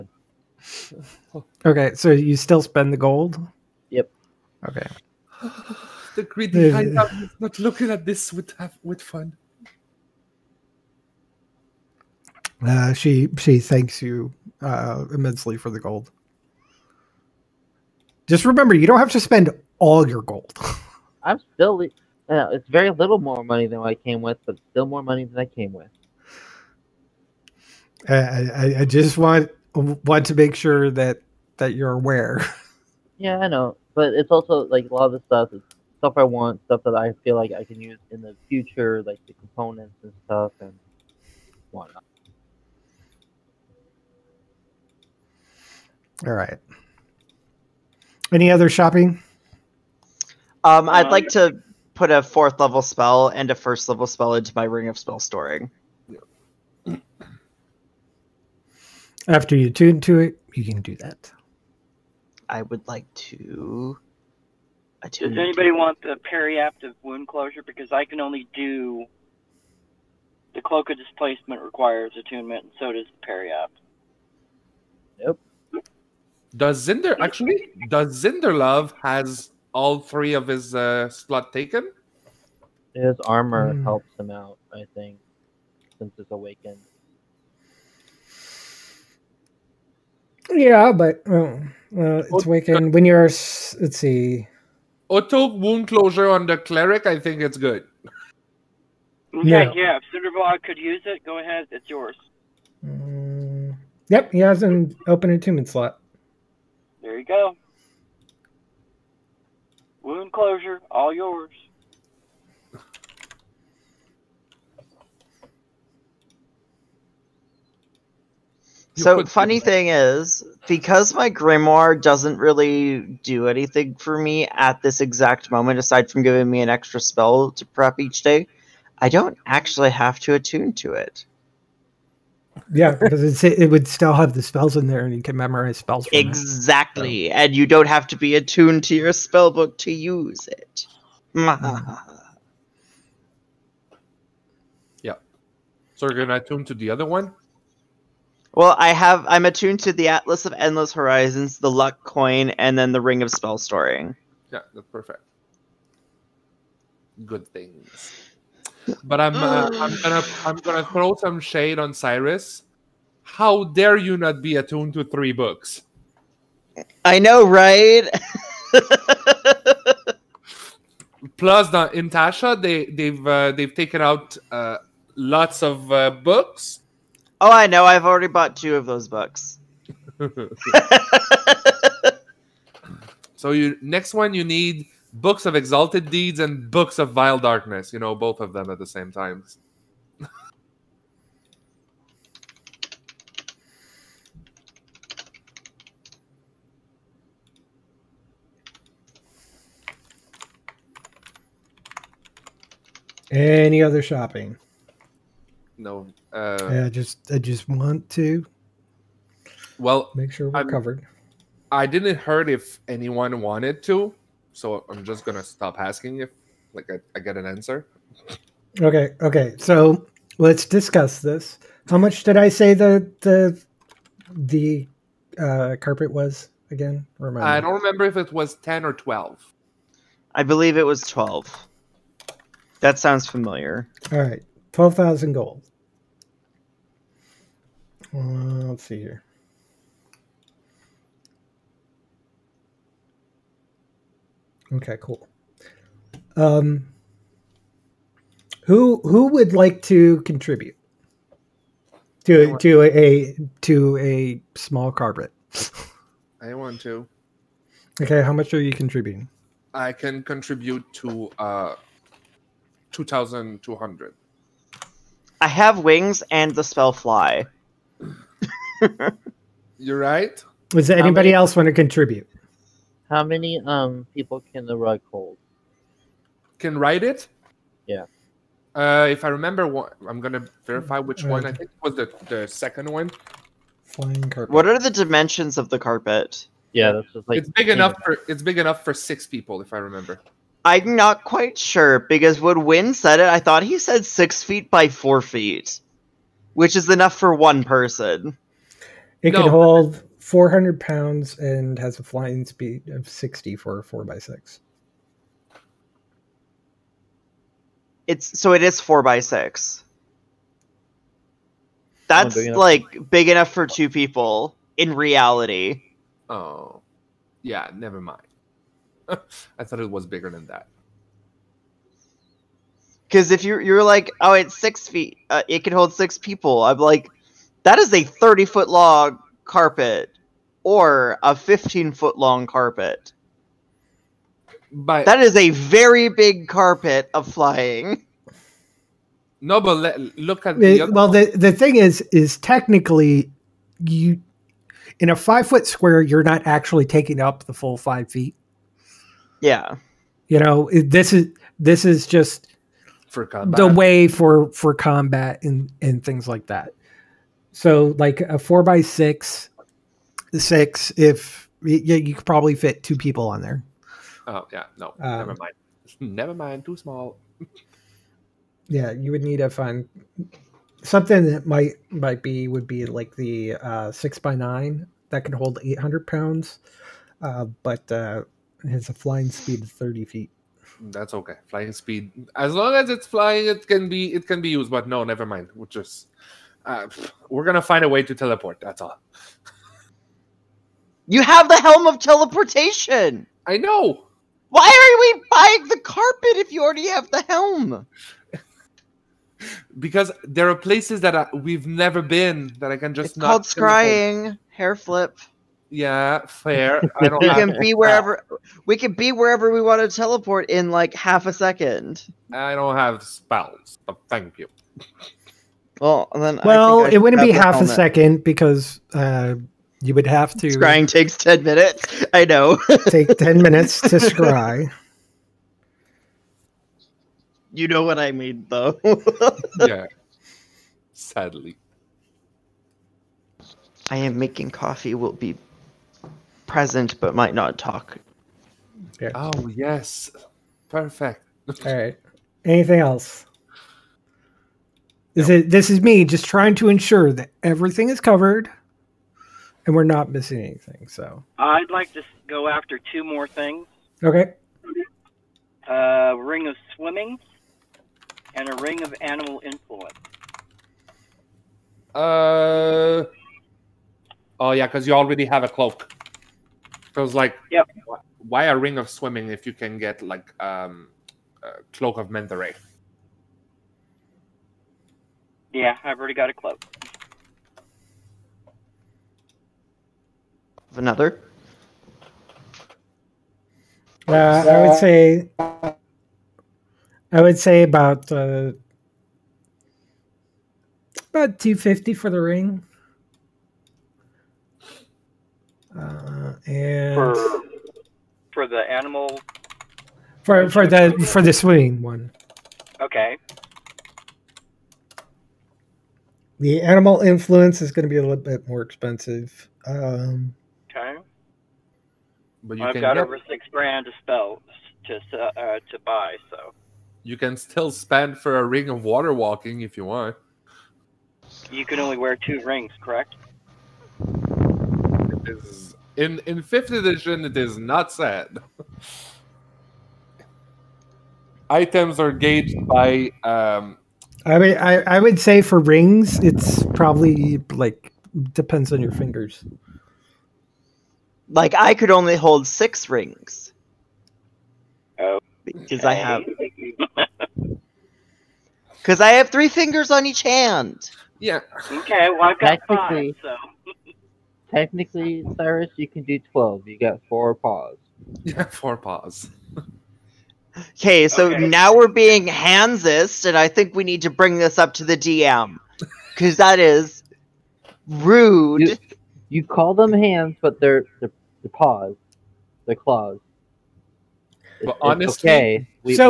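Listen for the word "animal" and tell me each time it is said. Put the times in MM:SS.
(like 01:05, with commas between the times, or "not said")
07:39, 08:18, 08:26.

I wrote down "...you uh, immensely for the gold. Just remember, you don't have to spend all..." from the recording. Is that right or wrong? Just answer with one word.
right.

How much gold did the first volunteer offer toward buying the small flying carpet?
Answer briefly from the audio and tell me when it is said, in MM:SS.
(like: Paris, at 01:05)
2,200 gold, at 04:22.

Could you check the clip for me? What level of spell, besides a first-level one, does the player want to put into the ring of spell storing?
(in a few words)
Fourth level.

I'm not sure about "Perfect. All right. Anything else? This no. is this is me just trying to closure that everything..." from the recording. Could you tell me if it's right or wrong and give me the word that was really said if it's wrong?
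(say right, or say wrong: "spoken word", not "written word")
wrong: "ensure", not "closure".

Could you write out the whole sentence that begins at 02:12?
Yeah, because it would still have the spells in there, and you can memorize spells.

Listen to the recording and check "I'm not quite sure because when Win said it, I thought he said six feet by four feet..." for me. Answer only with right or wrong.
right.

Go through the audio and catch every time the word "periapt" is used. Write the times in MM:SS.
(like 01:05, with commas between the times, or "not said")
01:06, 01:13.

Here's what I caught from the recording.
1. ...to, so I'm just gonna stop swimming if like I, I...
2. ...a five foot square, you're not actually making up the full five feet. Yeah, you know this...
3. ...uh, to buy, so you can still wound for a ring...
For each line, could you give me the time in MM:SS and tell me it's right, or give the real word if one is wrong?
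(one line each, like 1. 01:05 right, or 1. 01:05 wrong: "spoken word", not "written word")
1. 03:33 wrong: "asking", not "swimming"
2. 05:45 wrong: "taking", not "making"
3. 08:35 wrong: "spend", not "wound".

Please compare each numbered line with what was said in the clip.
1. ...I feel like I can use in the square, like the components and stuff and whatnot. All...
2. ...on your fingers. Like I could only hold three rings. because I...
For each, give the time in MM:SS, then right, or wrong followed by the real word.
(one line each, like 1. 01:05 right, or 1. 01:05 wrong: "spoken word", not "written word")
1. 00:36 wrong: "future", not "square"
2. 08:58 wrong: "six", not "three".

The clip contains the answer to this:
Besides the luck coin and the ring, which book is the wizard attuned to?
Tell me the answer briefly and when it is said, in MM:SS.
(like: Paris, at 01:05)
Atlas of Endless Horizons, at 02:30.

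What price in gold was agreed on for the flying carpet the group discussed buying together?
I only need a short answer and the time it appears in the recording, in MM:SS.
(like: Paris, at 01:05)
12,000 gold, at 03:54.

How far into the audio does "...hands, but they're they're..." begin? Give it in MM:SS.
09:29.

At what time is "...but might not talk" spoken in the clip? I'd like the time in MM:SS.
07:16.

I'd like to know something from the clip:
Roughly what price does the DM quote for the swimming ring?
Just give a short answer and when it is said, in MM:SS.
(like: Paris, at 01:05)
250 gold, at 08:11.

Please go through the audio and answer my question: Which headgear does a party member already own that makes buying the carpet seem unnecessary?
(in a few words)
Helm of teleportation.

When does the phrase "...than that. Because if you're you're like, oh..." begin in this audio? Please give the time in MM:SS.
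05:20.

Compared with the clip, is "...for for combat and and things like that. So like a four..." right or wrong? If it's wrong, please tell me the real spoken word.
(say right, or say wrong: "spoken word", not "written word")
right.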